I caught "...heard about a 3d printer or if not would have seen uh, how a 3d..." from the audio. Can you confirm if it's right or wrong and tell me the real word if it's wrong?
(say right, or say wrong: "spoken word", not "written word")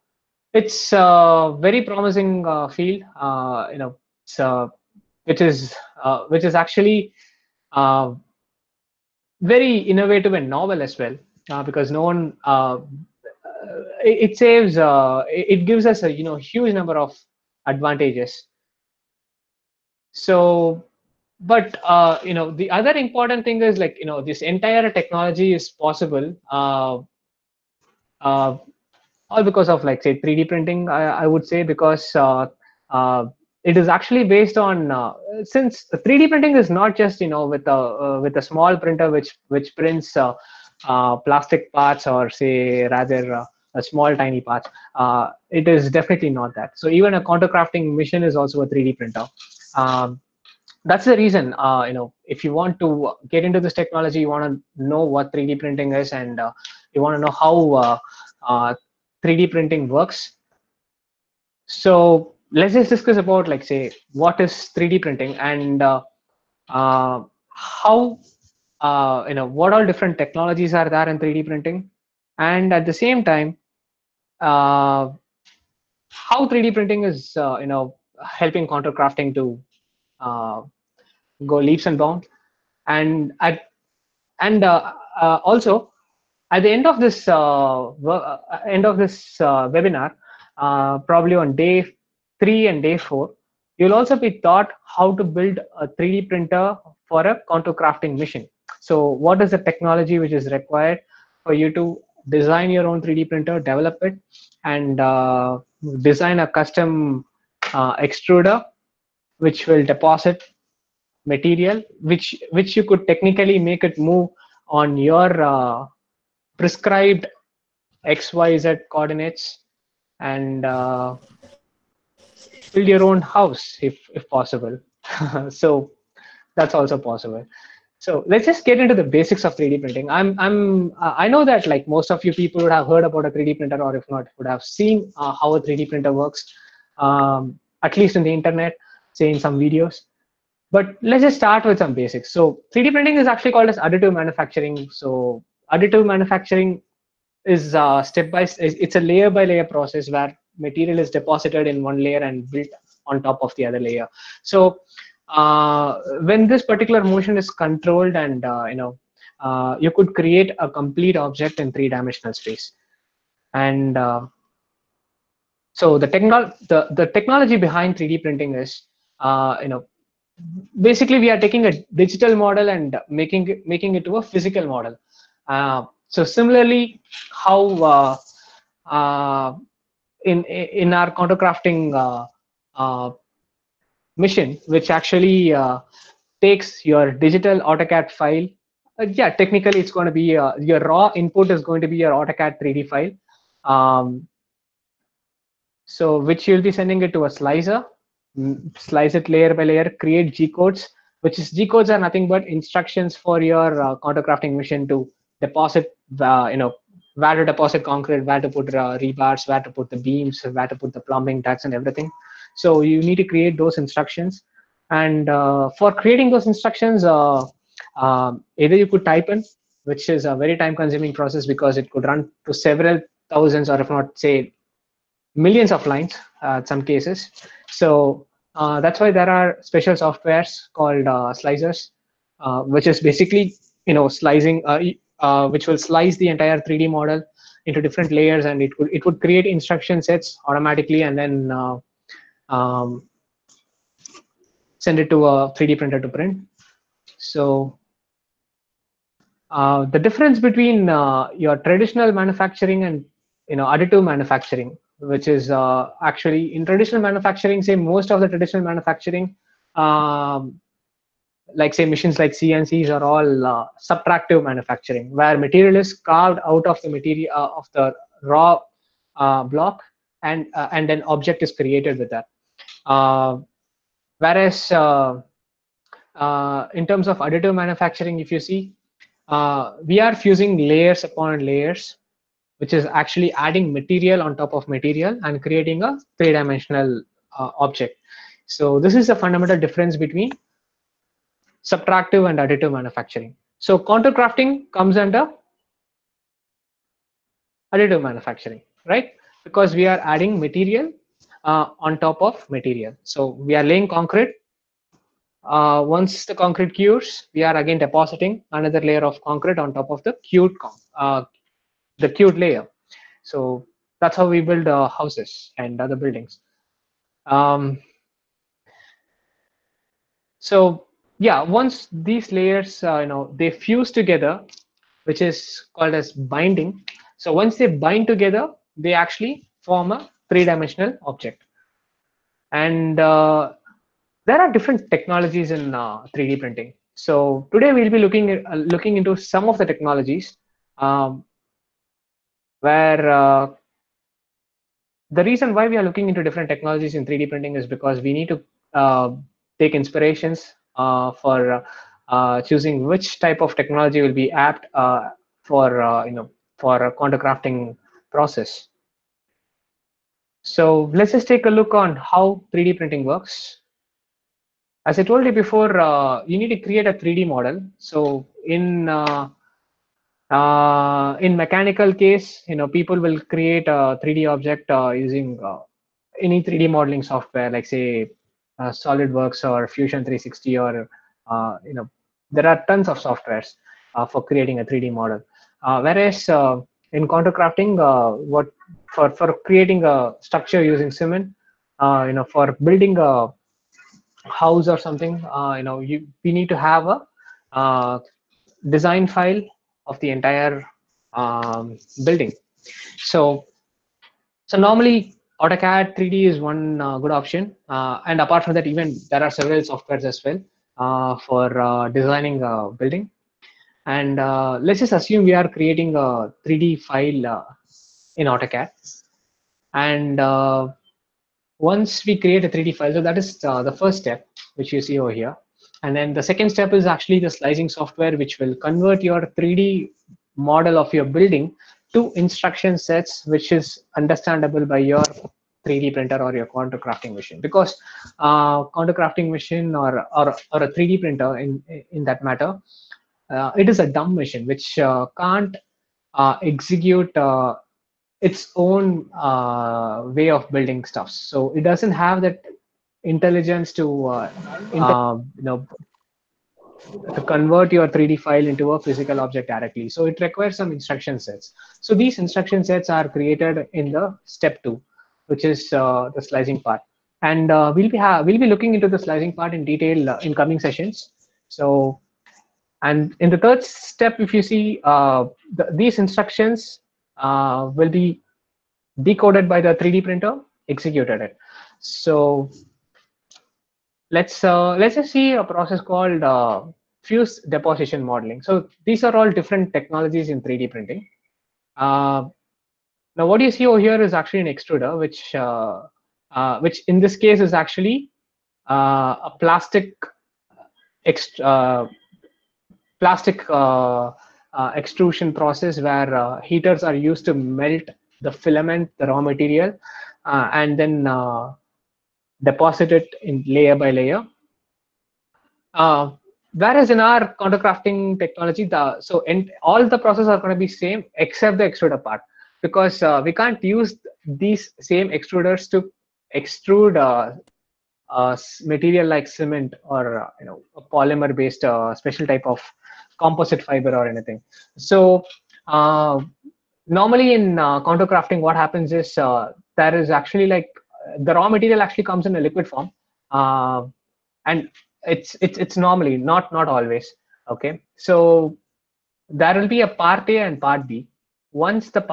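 right.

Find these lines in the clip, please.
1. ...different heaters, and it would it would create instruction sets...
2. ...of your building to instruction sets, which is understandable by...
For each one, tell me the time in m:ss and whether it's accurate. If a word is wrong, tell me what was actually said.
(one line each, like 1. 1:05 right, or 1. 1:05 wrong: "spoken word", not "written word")
1. 3:57 wrong: "layers", not "heaters"
2. 7:10 right.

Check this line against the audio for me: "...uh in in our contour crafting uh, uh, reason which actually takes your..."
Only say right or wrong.
wrong.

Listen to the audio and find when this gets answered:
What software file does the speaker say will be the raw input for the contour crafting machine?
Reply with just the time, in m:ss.
3:12.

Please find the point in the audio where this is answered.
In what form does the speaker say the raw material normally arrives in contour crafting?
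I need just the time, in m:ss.
9:02.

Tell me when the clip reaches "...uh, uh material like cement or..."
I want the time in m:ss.
8:46.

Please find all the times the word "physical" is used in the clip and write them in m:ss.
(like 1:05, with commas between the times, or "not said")
2:54, 7:38.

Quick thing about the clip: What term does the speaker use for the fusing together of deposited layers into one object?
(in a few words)
Binding.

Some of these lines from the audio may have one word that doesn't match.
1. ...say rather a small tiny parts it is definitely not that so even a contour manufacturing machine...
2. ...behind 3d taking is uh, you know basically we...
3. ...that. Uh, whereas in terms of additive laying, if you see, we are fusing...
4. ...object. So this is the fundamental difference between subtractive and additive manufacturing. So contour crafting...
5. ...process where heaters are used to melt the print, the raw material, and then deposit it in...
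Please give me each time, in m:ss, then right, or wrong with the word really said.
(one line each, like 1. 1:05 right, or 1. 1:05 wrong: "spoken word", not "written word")
1. 0:42 wrong: "crafting", not "manufacturing"
2. 2:47 wrong: "printing", not "taking"
3. 4:32 wrong: "manufacturing", not "laying"
4. 4:47 right
5. 8:25 wrong: "filament", not "print".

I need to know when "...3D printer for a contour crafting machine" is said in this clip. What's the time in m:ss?
1:35.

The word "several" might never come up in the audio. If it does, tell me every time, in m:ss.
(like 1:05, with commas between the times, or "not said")
3:42, 6:49.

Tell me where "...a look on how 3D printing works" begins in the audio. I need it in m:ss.
6:01.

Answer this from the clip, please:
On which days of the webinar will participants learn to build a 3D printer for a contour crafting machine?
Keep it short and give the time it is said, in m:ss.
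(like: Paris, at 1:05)
Day 3 and day 4, at 1:32.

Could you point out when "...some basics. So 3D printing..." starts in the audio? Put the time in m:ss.
2:21.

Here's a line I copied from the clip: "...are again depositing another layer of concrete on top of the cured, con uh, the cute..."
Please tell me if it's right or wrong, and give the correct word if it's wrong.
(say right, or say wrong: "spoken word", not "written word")
right.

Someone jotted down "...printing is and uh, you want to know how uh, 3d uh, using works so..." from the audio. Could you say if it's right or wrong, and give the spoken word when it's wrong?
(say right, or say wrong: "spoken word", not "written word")
wrong: "printing", not "using".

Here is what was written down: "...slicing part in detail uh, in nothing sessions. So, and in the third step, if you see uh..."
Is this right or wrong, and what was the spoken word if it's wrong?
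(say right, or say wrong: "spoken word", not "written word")
wrong: "coming", not "nothing".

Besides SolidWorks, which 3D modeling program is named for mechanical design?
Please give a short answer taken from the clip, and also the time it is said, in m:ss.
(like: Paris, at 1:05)
Fusion 360, at 6:19.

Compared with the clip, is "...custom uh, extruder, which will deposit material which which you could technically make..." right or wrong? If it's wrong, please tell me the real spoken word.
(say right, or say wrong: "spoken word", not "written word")
right.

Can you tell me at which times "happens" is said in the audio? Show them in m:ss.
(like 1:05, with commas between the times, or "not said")
8:58.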